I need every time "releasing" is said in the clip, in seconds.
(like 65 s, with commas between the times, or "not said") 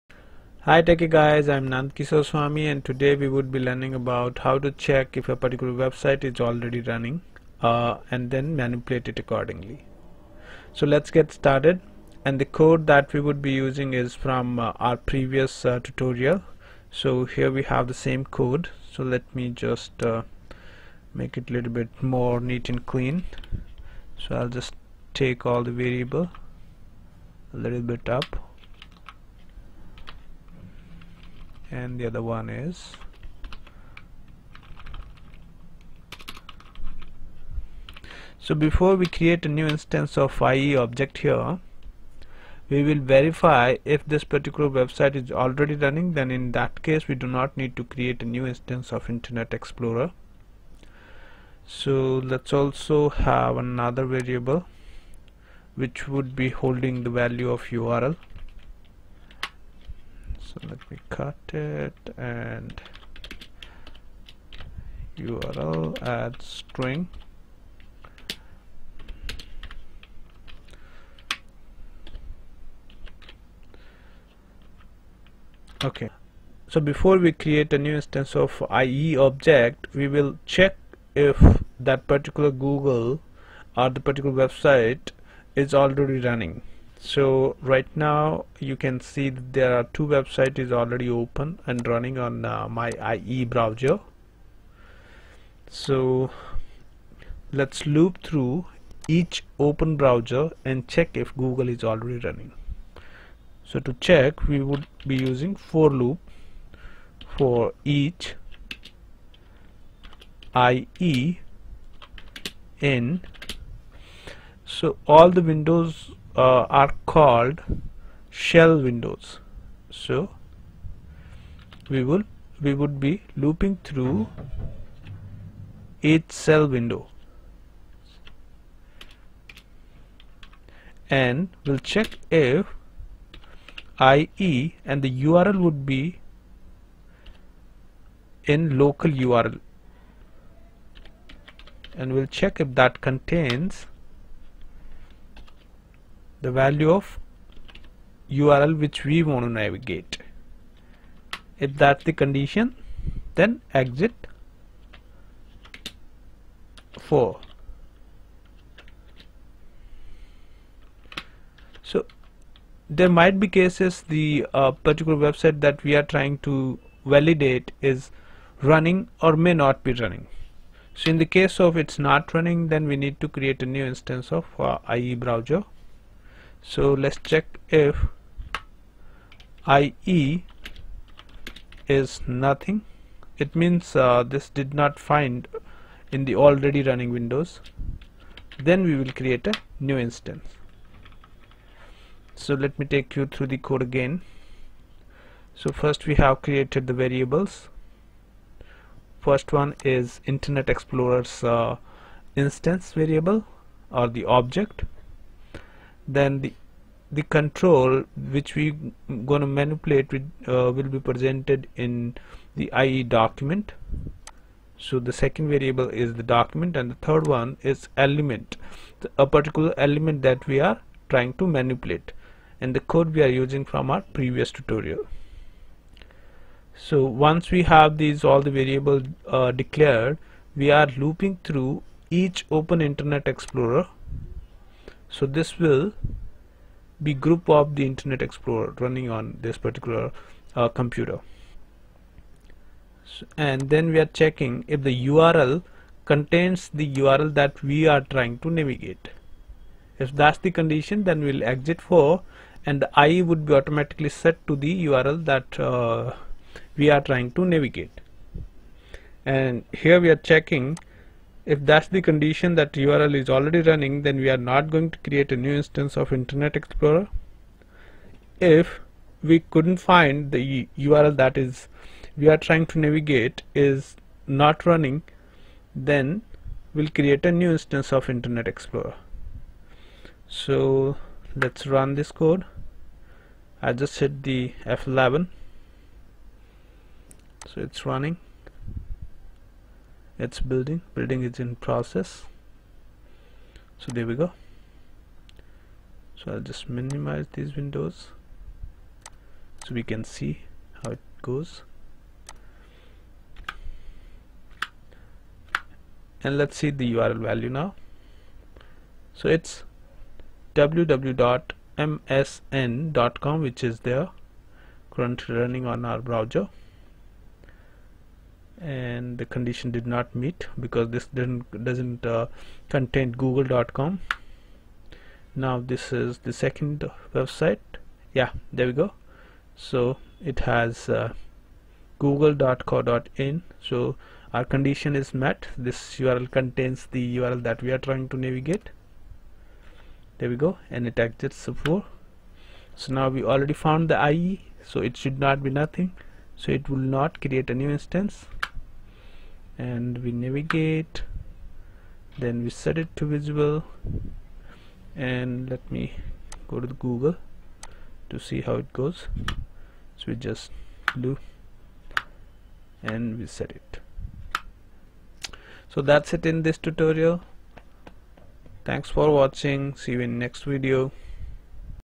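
not said.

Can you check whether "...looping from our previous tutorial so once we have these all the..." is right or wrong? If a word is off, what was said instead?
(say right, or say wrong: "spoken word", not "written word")
wrong: "using", not "looping".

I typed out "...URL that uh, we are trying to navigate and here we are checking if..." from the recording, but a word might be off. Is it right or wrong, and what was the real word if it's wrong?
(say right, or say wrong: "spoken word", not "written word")
right.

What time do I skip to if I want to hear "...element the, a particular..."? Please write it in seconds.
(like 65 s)
217 s.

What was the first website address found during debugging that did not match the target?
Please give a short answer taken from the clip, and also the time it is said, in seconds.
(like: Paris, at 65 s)
www.msn.com, at 310 s.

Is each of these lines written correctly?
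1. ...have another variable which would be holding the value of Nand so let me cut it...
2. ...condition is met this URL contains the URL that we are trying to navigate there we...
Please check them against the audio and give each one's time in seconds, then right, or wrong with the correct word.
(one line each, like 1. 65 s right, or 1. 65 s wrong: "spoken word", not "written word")
1. 53 s wrong: "URL", not "Nand"
2. 334 s right.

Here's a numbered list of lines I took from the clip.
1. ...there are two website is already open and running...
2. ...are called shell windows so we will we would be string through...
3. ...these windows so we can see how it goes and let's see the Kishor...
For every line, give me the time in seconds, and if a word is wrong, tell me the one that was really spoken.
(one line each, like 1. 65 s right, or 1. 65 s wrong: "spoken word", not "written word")
1. 89 s right
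2. 116 s wrong: "looping", not "string"
3. 297 s wrong: "URL", not "Kishor".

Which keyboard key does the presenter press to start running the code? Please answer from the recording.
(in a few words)
F11.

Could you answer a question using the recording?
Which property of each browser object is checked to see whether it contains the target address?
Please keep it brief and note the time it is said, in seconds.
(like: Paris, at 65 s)
local URL, at 138 s.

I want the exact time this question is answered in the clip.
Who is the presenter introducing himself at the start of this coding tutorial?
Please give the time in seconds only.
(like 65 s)
1 s.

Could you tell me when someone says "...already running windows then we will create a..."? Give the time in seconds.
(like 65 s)
186 s.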